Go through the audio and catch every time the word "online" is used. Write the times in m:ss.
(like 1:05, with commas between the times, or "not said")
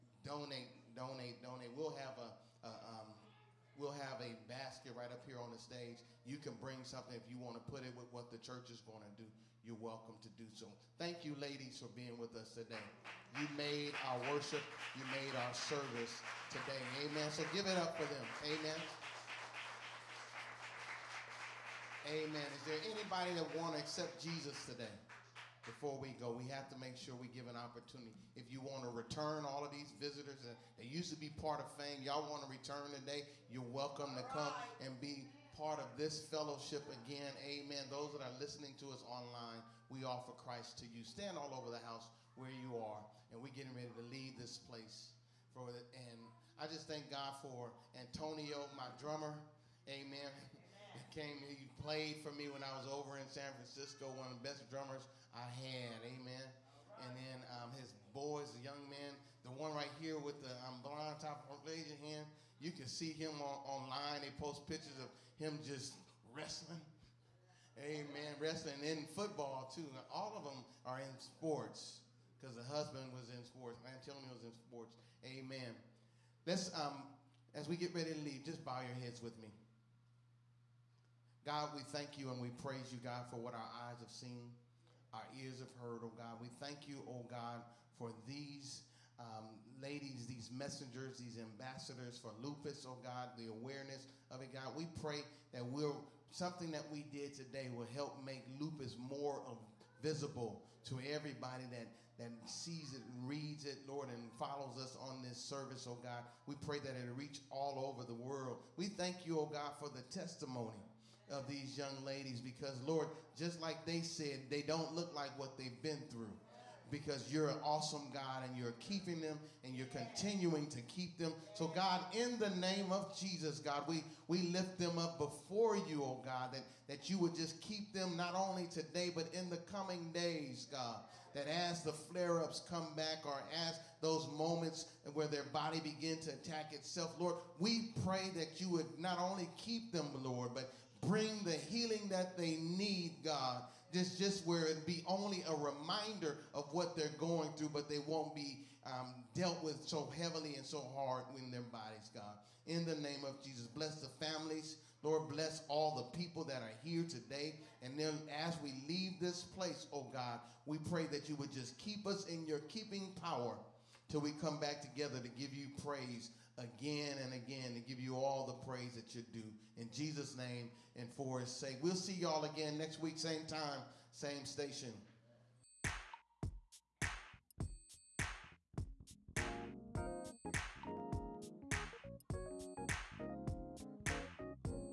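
0:39, 1:03.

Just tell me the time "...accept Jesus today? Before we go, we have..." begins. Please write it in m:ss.
0:23.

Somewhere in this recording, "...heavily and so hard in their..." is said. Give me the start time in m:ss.
2:30.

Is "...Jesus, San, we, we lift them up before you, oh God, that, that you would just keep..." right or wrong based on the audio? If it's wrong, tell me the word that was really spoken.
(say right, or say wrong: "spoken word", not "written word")
wrong: "God", not "San".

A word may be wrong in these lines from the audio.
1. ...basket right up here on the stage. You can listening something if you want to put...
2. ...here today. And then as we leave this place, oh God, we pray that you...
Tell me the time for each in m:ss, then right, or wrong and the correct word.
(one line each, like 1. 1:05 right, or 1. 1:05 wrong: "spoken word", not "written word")
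1. 0:04 wrong: "bring", not "listening"
2. 2:36 right.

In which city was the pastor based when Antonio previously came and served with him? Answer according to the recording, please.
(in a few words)
San Francisco.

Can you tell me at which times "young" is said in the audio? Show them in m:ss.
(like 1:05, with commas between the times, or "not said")
0:58, 1:51.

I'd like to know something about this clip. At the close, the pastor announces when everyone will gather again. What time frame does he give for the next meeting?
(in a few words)
Next week.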